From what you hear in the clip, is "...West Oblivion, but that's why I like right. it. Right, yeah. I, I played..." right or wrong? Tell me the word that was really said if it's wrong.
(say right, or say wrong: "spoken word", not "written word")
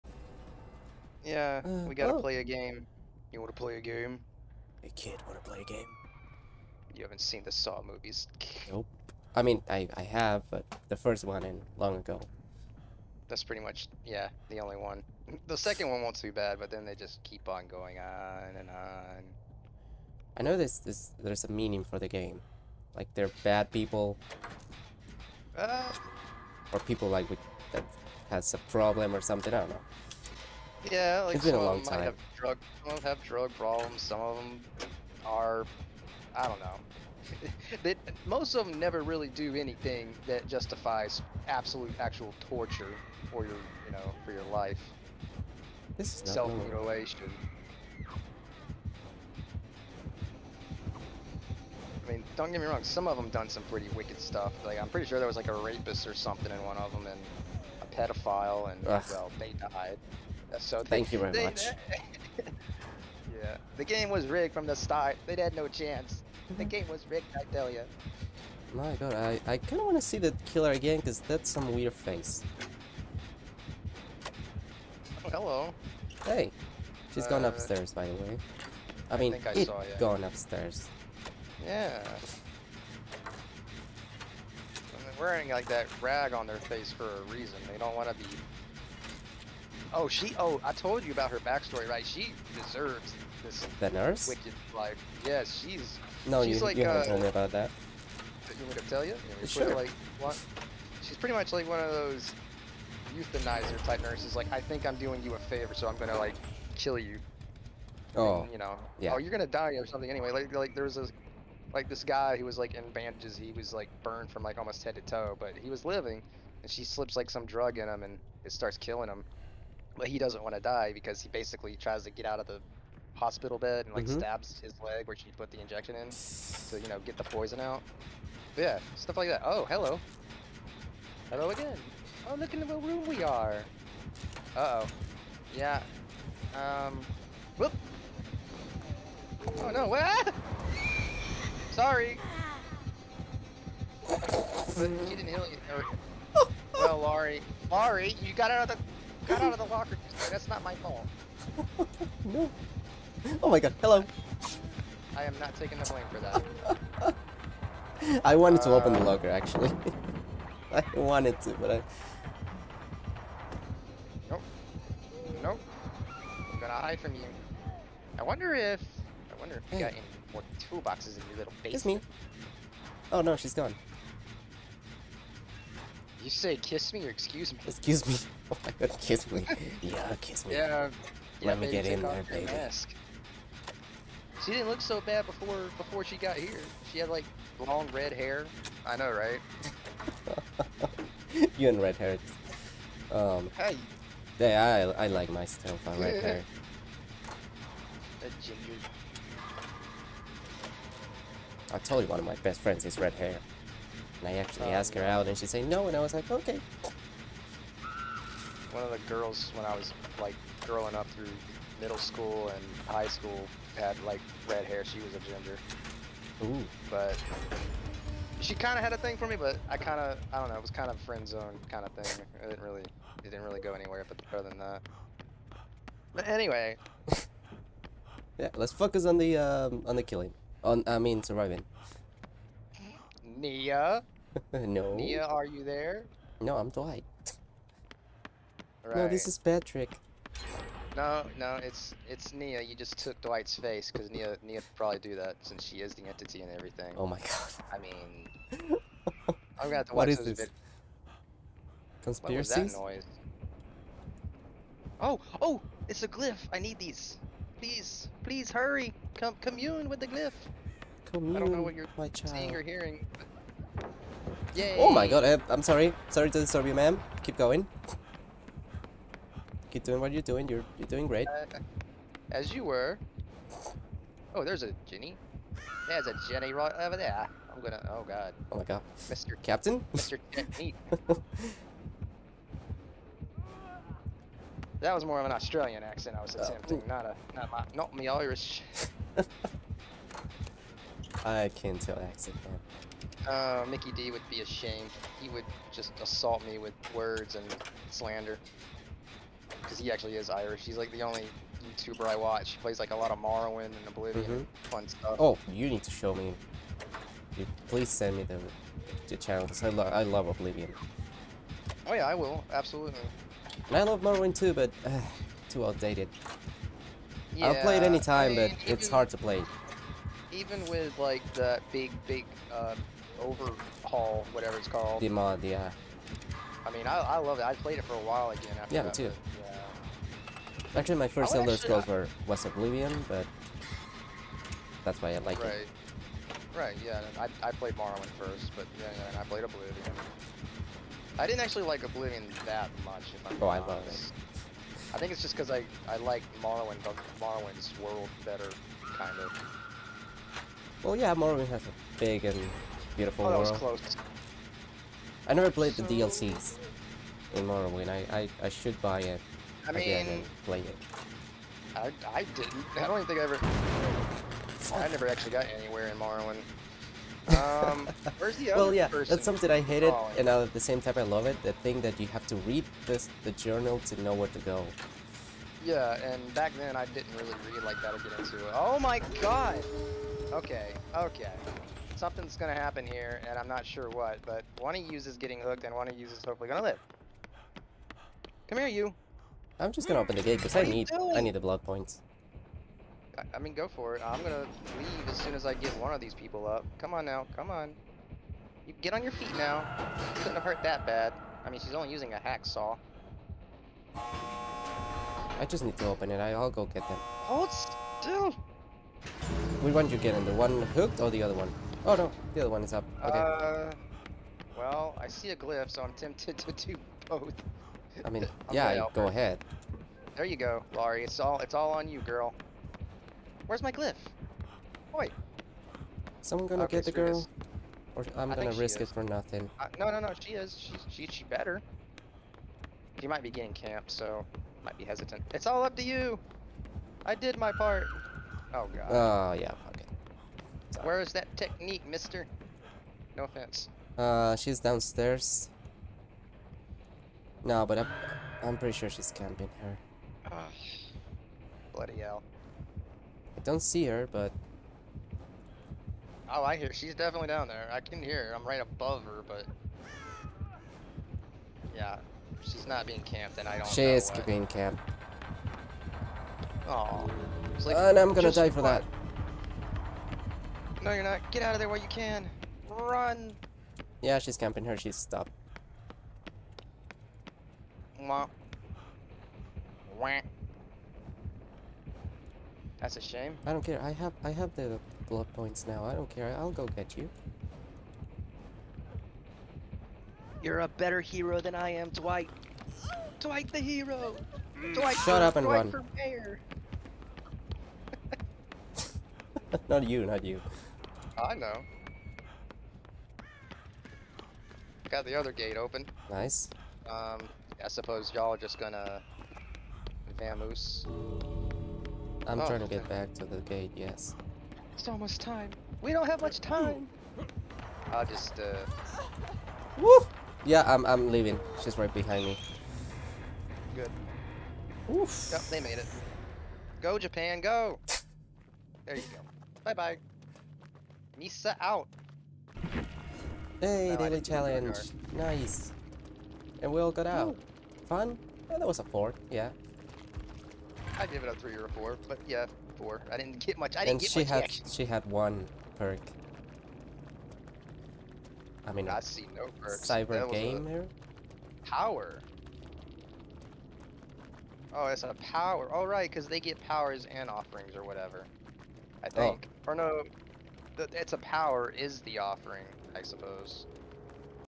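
right.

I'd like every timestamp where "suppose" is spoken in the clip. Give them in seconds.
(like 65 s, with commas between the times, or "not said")
507 s, 563 s.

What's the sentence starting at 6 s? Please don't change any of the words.
You haven't seen the Saw movies.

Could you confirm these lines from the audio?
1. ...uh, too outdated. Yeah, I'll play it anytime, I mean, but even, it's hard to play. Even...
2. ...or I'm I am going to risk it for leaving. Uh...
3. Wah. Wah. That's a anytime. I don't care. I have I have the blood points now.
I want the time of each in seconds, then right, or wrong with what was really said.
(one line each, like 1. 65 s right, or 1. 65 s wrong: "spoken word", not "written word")
1. 314 s right
2. 427 s wrong: "nothing", not "leaving"
3. 477 s wrong: "shame", not "anytime".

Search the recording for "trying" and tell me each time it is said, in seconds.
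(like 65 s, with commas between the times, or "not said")
512 s.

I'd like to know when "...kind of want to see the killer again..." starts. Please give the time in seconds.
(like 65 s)
69 s.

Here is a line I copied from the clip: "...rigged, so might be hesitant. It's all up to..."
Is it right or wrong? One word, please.
wrong.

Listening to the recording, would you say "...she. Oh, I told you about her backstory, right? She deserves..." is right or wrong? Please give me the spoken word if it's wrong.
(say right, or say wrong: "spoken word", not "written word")
right.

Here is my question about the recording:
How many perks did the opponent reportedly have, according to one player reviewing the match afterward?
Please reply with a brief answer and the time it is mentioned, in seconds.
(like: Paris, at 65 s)
1, at 545 s.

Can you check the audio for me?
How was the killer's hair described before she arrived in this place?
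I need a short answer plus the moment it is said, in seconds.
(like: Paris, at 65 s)
long red hair, at 187 s.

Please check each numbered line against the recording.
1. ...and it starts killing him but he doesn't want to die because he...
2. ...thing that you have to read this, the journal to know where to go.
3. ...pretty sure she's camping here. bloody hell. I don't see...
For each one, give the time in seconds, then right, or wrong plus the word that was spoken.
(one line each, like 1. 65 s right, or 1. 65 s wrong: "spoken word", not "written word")
1. 118 s right
2. 371 s right
3. 448 s right.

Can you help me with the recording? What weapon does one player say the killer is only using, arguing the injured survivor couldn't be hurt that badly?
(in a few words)
hacksaw.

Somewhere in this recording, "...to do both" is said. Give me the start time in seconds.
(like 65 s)
416 s.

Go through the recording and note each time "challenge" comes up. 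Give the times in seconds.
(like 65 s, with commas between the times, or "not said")
534 s.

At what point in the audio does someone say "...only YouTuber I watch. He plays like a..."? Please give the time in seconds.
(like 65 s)
301 s.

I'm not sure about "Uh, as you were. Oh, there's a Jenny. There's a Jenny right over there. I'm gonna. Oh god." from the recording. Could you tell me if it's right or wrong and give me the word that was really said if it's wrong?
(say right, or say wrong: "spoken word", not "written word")
right.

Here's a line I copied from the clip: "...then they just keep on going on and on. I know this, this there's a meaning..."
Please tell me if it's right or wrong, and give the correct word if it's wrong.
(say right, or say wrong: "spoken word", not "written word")
right.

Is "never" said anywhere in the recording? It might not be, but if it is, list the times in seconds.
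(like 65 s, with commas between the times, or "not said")
38 s, 355 s, 364 s.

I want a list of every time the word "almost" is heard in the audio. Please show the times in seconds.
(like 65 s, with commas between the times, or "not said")
114 s, 514 s.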